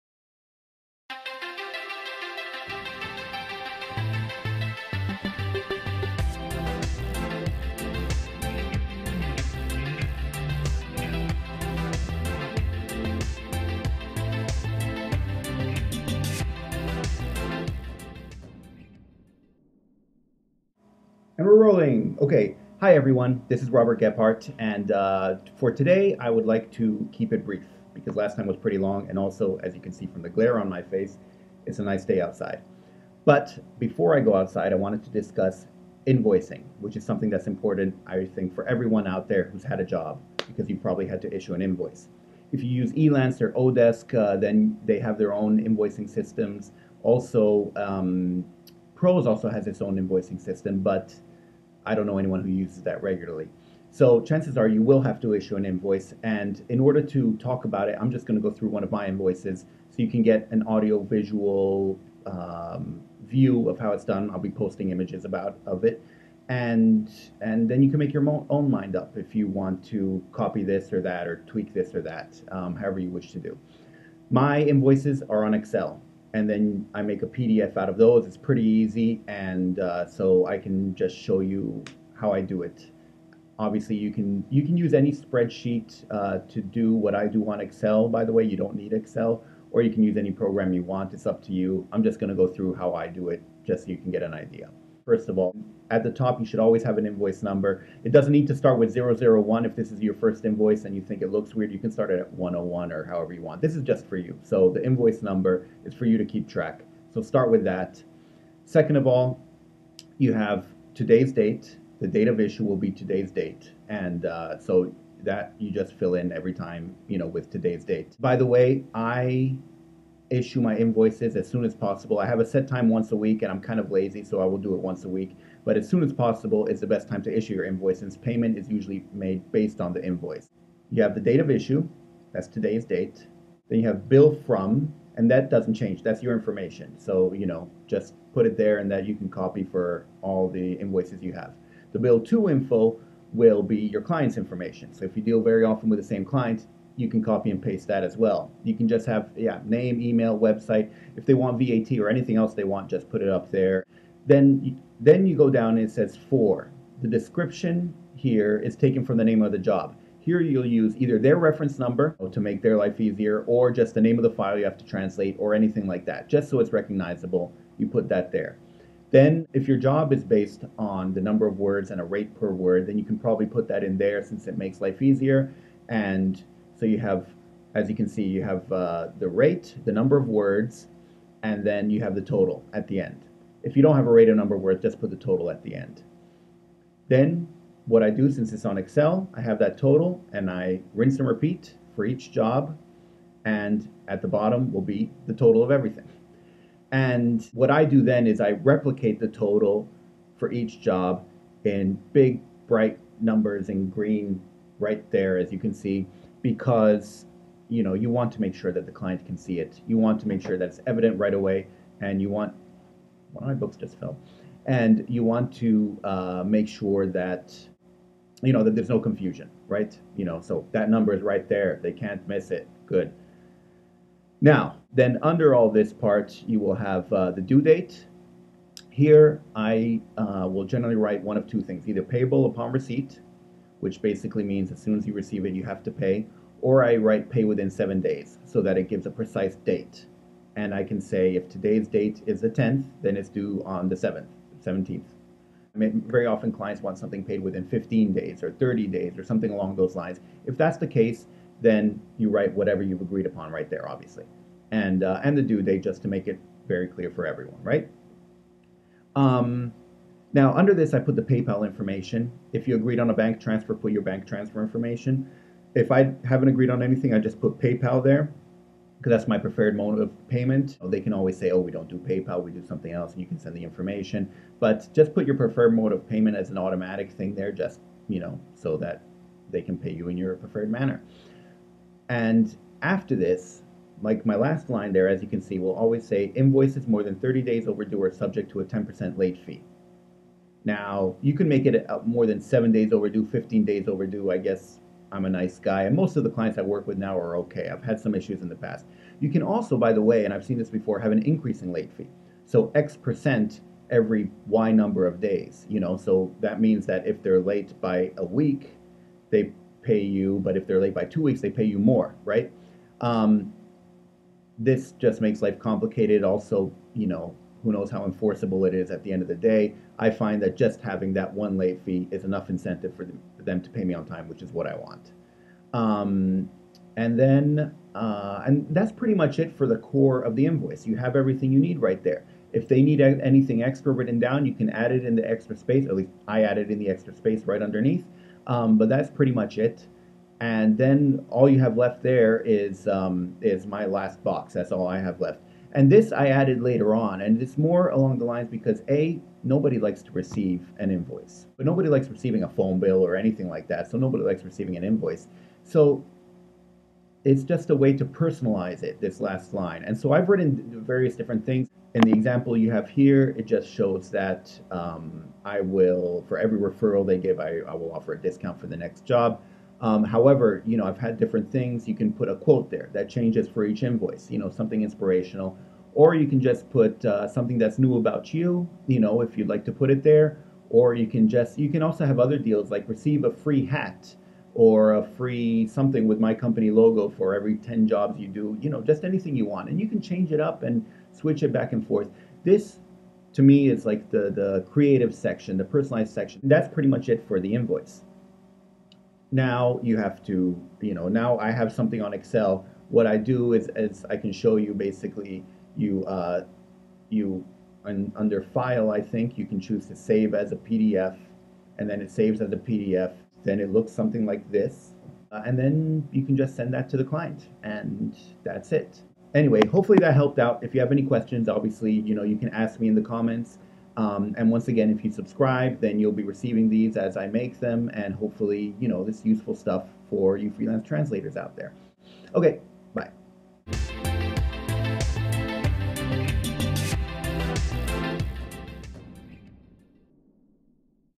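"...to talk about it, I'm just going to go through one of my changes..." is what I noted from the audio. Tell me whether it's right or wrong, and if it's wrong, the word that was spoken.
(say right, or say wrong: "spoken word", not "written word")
wrong: "invoices", not "changes".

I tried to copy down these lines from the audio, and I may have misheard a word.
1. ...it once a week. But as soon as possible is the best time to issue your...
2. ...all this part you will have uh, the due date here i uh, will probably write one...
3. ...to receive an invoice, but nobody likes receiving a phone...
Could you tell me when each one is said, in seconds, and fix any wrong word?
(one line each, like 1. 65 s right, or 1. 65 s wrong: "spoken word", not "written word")
1. 124 s right
2. 225 s wrong: "generally", not "probably"
3. 350 s right.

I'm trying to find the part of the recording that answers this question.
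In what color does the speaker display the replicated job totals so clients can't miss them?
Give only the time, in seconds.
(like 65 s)
203 s.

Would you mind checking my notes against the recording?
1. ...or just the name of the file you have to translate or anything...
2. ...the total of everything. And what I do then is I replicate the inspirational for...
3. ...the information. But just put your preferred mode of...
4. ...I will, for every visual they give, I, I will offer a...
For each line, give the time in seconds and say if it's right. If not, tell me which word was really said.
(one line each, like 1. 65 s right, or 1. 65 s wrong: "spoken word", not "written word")
1. 163 s right
2. 195 s wrong: "total", not "inspirational"
3. 273 s right
4. 365 s wrong: "referral", not "visual".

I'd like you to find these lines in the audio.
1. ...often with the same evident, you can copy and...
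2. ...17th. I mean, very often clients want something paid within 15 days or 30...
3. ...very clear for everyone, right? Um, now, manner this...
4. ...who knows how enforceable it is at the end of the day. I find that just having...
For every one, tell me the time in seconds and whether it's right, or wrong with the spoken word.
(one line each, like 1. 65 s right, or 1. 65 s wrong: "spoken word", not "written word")
1. 145 s wrong: "client", not "evident"
2. 244 s right
3. 256 s wrong: "under", not "manner"
4. 317 s right.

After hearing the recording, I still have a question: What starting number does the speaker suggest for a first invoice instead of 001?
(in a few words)
101.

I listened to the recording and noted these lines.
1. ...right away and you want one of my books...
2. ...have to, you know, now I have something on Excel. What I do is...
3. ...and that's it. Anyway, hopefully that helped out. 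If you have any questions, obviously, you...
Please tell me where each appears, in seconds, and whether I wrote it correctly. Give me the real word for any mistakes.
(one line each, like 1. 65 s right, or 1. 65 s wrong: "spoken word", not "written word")
1. 211 s right
2. 399 s right
3. 417 s right.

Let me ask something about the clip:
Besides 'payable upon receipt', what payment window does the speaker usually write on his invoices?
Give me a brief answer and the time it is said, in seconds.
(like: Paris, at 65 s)
within 7 days, at 237 s.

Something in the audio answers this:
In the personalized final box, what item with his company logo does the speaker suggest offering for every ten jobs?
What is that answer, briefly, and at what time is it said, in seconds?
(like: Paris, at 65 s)
a free hat, at 383 s.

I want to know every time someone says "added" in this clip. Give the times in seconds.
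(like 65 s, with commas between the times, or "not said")
336 s, 346 s.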